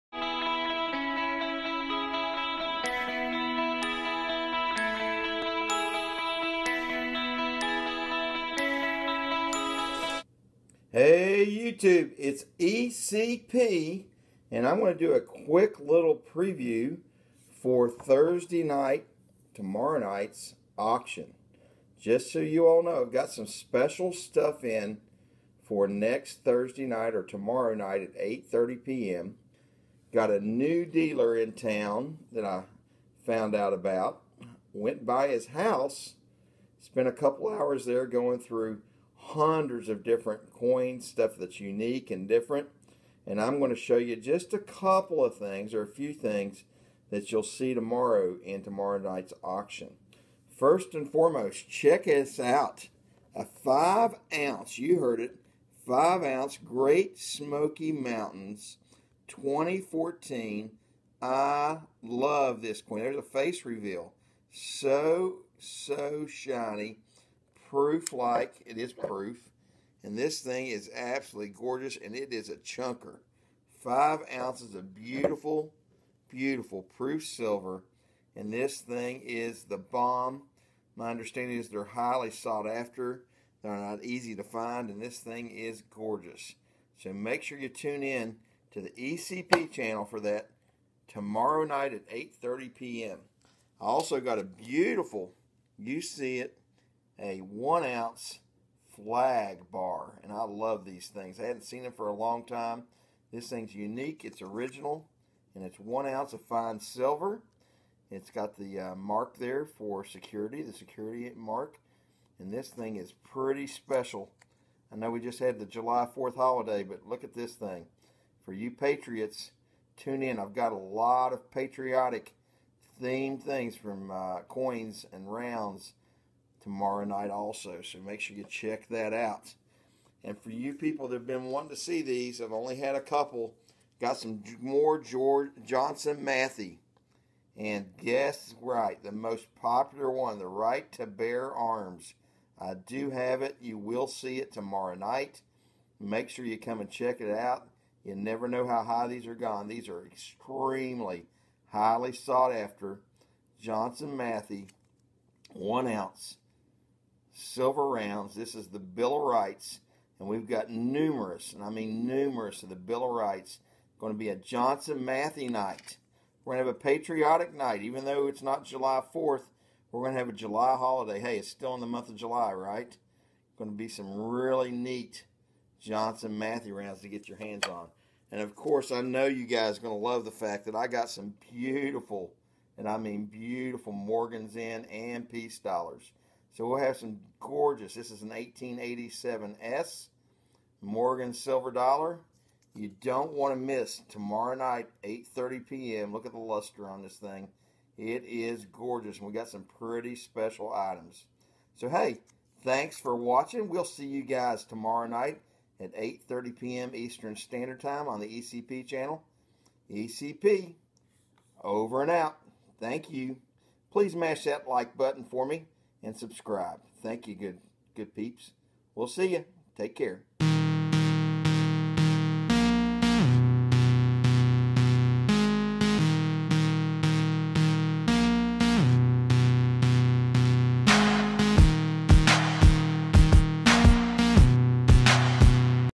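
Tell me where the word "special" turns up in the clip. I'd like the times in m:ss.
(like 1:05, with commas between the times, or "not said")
0:23, 1:53, 3:20.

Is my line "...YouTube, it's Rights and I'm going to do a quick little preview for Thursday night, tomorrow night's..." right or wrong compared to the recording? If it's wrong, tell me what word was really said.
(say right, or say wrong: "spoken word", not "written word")
wrong: "ECP", not "Rights".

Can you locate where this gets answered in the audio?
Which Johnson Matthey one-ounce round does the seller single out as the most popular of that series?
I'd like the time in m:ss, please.
2:20.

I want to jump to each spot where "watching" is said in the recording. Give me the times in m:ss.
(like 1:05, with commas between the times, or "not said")
3:23.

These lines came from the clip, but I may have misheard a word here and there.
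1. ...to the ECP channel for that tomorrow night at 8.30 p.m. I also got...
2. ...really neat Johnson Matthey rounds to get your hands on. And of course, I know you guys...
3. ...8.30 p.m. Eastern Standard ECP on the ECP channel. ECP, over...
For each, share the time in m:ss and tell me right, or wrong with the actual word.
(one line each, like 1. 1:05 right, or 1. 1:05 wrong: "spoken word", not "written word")
1. 1:28 right
2. 2:54 right
3. 3:25 wrong: "Time", not "ECP".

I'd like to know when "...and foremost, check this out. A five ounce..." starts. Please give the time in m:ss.
0:50.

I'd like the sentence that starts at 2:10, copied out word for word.
And for you people that have been wanting to see these, I've only had a couple.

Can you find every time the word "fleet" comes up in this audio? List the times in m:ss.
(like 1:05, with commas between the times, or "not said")
not said.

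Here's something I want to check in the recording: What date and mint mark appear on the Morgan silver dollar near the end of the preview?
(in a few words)
1887S.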